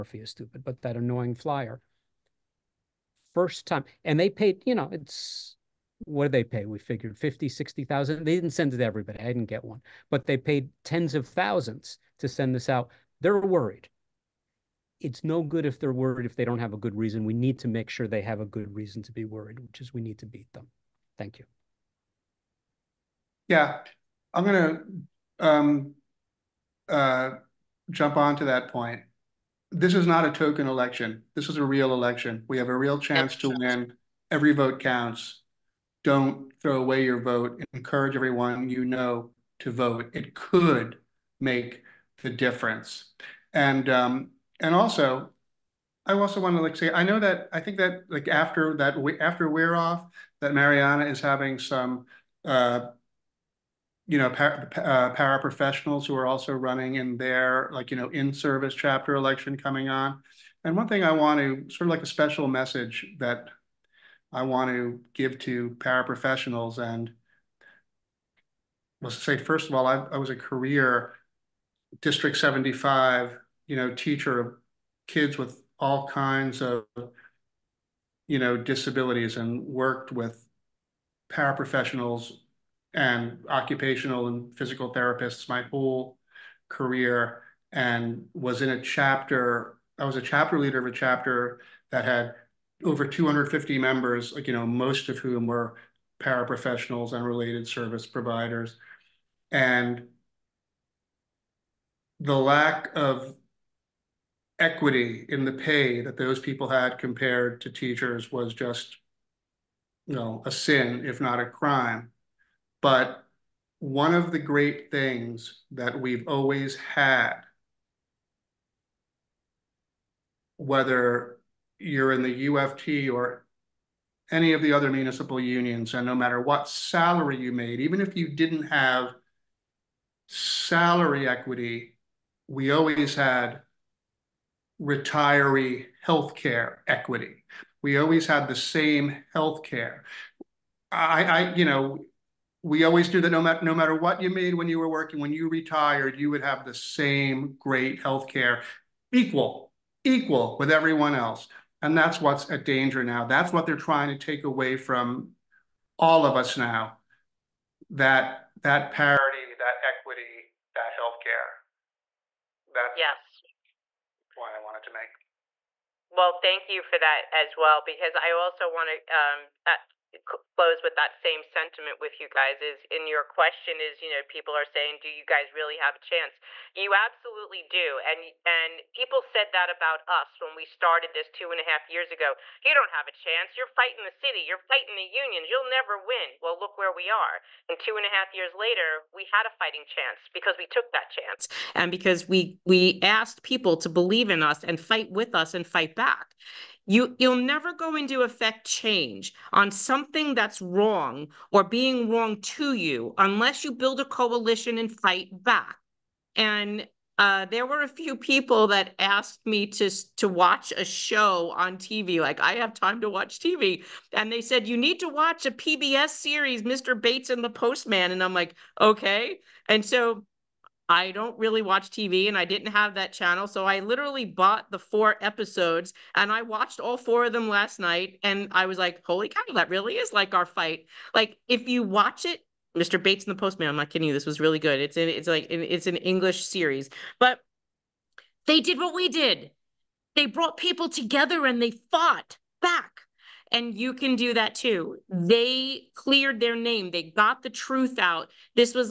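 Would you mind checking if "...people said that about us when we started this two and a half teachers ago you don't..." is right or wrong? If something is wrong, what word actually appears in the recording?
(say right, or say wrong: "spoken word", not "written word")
wrong: "years", not "teachers".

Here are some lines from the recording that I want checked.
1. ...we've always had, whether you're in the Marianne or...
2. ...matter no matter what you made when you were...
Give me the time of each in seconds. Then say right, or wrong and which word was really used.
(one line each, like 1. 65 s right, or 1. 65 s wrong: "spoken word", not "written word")
1. 115 s wrong: "UFT", not "Marianne"
2. 143 s right.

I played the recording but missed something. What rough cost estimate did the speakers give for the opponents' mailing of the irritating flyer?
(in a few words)
50, 60,000.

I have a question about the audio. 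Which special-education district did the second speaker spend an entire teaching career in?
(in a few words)
District 75.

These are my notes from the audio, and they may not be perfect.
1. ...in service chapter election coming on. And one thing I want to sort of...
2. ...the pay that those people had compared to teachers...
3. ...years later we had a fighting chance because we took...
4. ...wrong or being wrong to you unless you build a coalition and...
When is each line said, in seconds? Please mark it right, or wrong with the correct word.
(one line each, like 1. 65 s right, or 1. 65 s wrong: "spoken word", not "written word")
1. 58 s right
2. 105 s right
3. 188 s right
4. 200 s right.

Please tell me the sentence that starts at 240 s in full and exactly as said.
They brought people together and they fought back and you can do that too.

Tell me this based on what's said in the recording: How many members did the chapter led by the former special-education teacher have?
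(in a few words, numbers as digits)
Over 250.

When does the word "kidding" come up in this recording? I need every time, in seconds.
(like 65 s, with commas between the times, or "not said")
233 s.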